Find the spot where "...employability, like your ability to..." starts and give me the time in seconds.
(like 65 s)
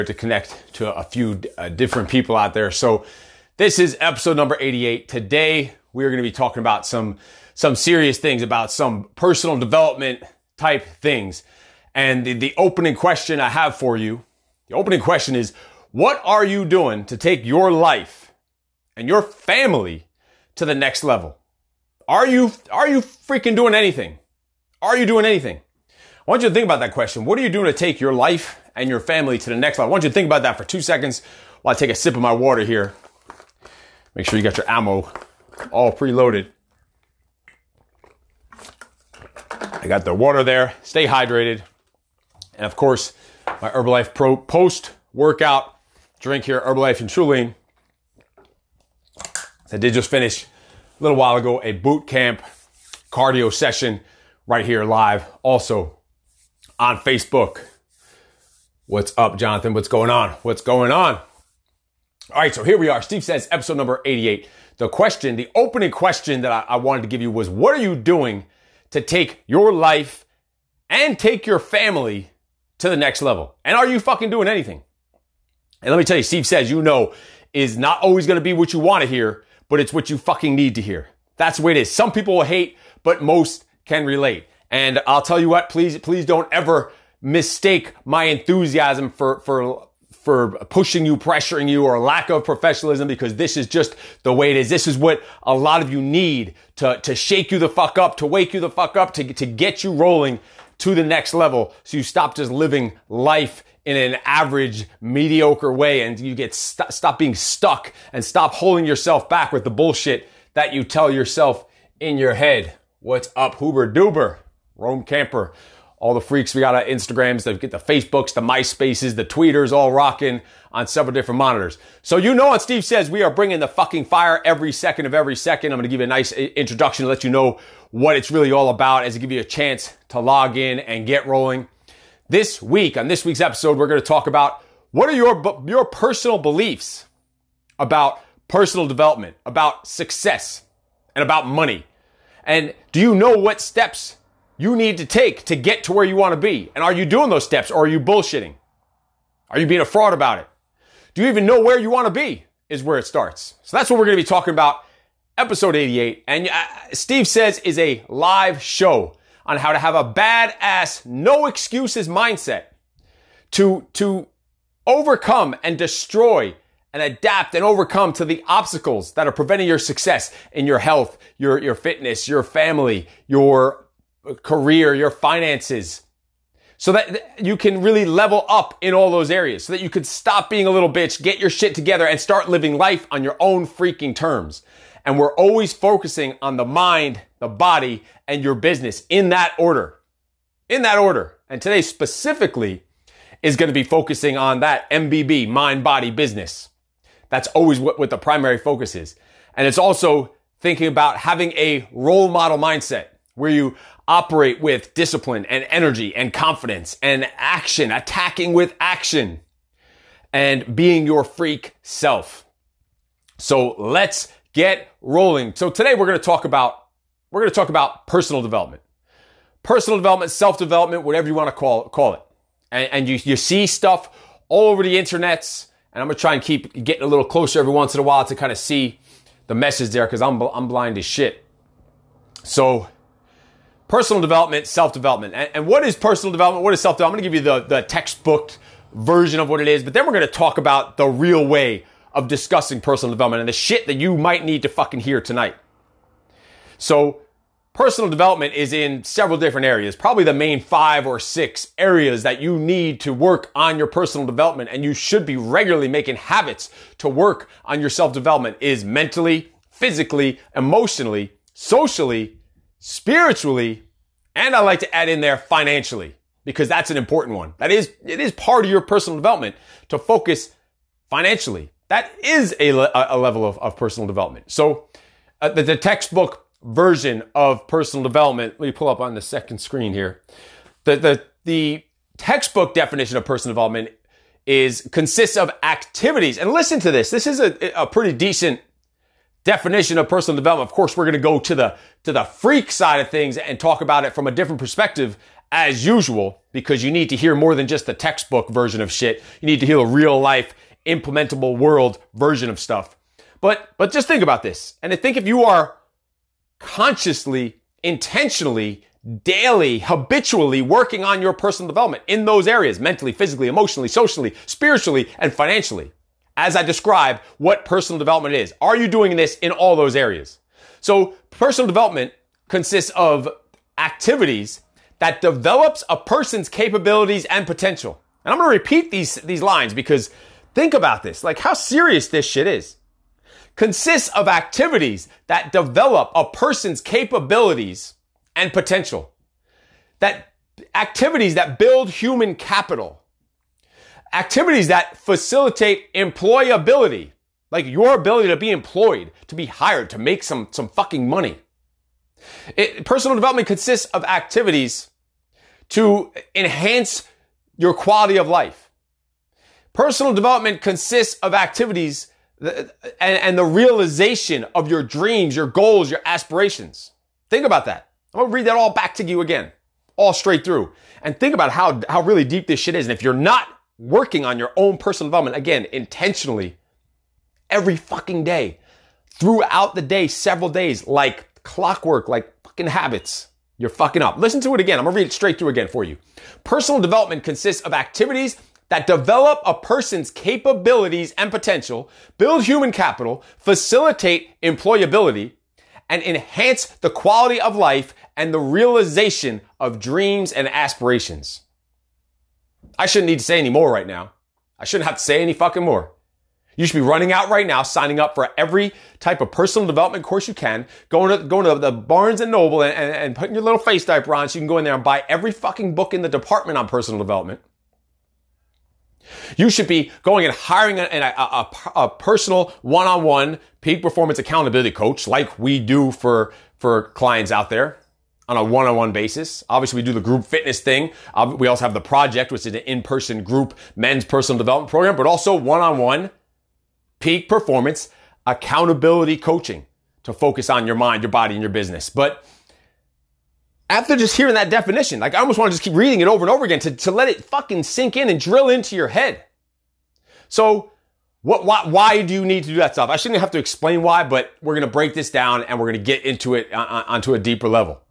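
345 s.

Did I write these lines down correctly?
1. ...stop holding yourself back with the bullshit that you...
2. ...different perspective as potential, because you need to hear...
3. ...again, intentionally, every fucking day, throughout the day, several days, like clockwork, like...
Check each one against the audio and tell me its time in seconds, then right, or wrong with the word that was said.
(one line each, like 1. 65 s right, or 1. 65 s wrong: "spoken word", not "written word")
1. 108 s right
2. 294 s wrong: "usual", not "potential"
3. 375 s right.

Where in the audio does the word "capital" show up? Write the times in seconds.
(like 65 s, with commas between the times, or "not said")
342 s, 392 s.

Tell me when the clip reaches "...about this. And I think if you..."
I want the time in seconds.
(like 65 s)
304 s.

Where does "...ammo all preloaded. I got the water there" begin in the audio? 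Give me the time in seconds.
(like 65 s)
34 s.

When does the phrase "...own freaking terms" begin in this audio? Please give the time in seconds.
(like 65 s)
183 s.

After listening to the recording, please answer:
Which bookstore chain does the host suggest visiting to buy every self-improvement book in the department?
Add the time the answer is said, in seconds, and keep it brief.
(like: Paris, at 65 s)
Barnes and Noble, at 411 s.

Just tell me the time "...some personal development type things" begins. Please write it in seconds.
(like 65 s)
8 s.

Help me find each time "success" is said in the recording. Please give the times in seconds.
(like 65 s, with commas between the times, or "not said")
139 s, 169 s.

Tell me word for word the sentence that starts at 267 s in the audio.
That is, it is part of your personal development to focus financially.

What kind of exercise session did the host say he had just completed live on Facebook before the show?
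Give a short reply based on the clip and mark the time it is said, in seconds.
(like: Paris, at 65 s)
boot camp cardio, at 51 s.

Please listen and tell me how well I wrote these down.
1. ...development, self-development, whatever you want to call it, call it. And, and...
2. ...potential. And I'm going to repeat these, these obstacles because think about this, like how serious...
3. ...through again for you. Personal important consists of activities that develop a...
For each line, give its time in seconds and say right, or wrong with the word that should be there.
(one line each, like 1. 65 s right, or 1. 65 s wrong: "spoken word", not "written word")
1. 219 s right
2. 327 s wrong: "lines", not "obstacles"
3. 385 s wrong: "development", not "important".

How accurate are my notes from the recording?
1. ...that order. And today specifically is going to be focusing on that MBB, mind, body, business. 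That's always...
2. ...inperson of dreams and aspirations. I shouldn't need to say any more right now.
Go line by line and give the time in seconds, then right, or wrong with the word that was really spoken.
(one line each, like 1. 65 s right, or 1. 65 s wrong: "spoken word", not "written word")
1. 190 s right
2. 398 s wrong: "realization", not "inperson".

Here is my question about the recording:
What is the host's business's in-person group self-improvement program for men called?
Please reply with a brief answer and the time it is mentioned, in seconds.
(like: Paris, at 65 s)
the project, at 431 s.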